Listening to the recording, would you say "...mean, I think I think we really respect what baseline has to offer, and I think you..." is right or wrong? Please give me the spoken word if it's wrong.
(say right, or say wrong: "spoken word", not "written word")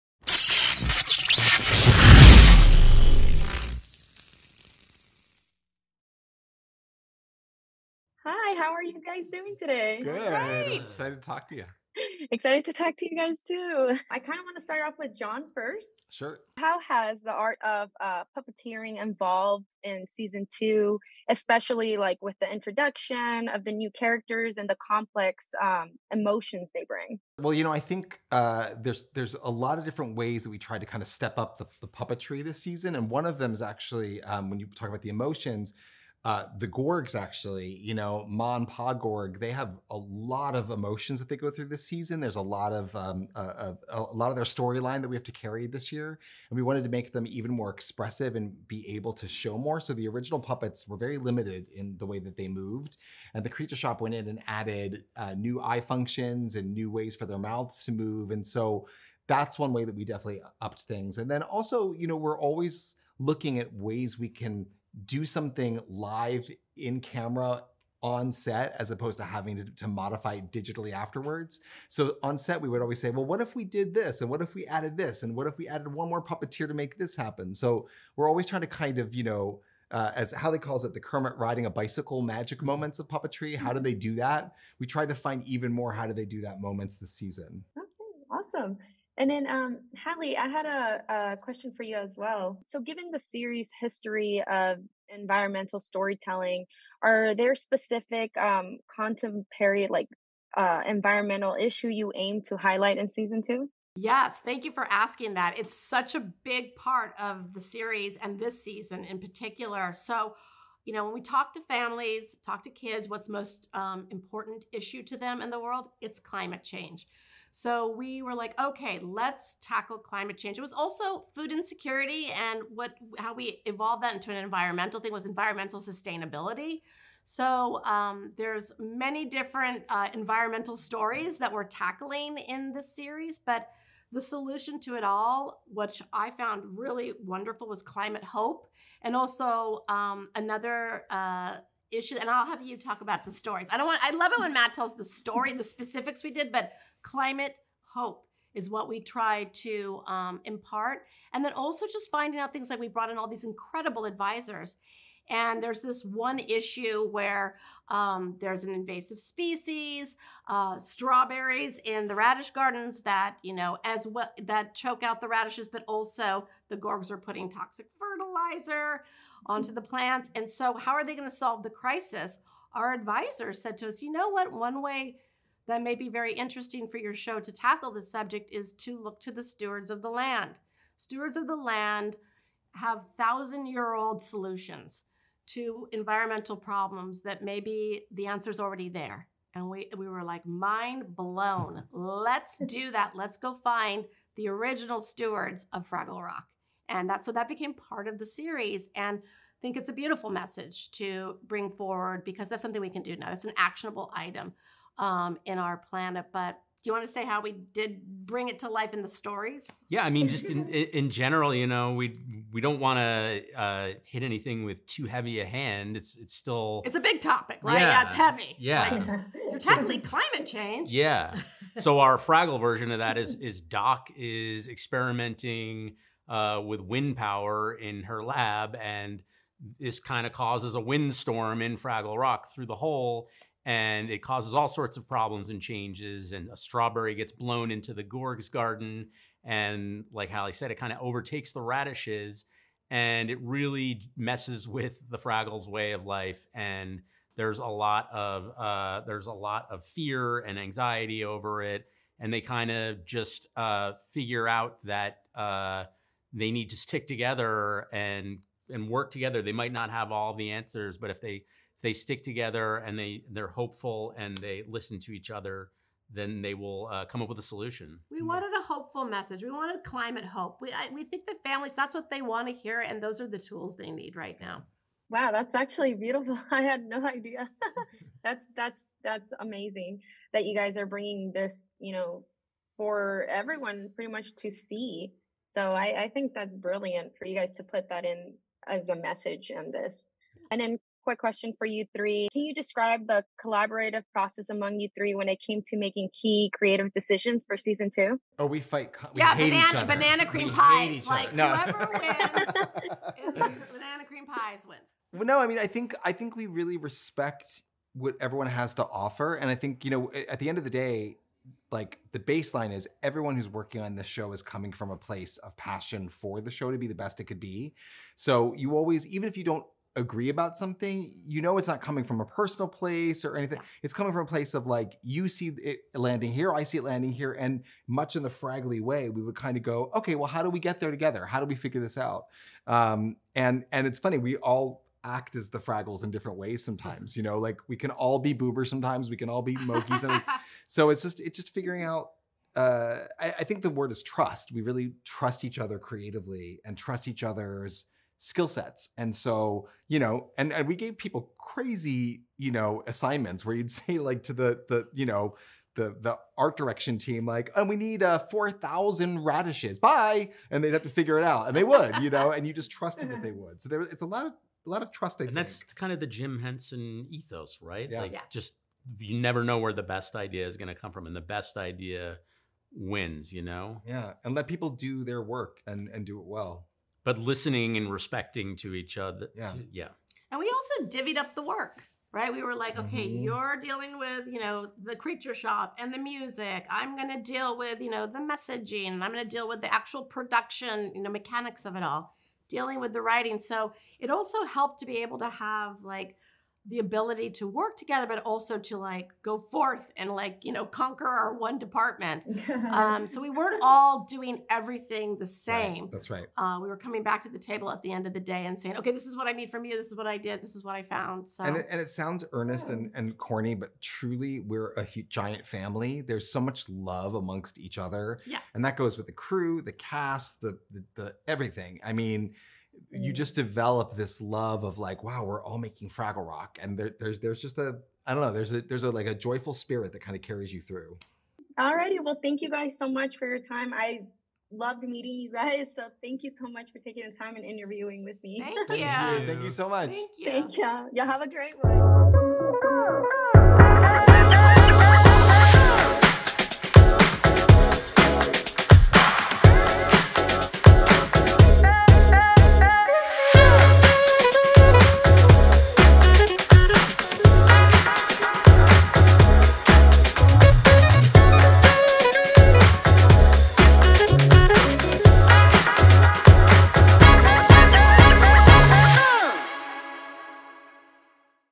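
wrong: "everyone", not "baseline".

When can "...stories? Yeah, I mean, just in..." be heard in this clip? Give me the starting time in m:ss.
3:29.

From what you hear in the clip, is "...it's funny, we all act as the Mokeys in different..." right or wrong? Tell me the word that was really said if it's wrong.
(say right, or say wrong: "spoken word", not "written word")
wrong: "Fraggles", not "Mokeys".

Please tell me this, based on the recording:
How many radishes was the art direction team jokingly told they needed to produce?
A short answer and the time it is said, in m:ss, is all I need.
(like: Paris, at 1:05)
4,000, at 5:58.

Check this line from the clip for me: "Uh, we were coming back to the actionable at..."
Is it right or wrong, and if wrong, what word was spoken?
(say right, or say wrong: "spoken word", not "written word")
wrong: "table", not "actionable".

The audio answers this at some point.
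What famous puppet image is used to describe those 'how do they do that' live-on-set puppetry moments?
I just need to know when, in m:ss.
1:20.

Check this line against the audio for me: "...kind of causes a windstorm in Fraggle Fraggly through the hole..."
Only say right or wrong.
wrong.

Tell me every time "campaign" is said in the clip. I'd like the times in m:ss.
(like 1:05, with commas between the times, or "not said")
not said.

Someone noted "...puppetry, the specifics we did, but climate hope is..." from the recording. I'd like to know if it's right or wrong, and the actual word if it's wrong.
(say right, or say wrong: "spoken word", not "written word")
wrong: "story", not "puppetry".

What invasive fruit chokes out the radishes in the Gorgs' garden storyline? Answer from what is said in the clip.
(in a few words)
Strawberries.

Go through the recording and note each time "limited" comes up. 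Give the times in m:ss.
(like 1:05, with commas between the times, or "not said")
0:51.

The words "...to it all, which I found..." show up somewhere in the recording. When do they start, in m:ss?
2:14.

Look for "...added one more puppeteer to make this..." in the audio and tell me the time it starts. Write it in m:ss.
1:15.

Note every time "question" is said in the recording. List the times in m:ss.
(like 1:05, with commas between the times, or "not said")
1:31, 4:51.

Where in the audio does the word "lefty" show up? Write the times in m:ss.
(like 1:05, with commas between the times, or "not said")
not said.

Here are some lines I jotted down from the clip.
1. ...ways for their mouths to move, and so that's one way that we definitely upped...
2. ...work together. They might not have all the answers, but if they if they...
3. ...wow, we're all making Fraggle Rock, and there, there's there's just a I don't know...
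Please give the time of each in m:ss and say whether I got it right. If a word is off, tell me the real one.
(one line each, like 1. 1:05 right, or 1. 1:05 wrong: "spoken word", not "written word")
1. 0:56 right
2. 4:18 right
3. 7:05 right.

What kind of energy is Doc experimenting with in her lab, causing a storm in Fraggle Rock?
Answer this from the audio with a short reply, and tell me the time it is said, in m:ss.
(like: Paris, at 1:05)
Wind power, at 3:46.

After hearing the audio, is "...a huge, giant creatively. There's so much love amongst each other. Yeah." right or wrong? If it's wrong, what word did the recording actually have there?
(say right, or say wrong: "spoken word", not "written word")
wrong: "family", not "creatively".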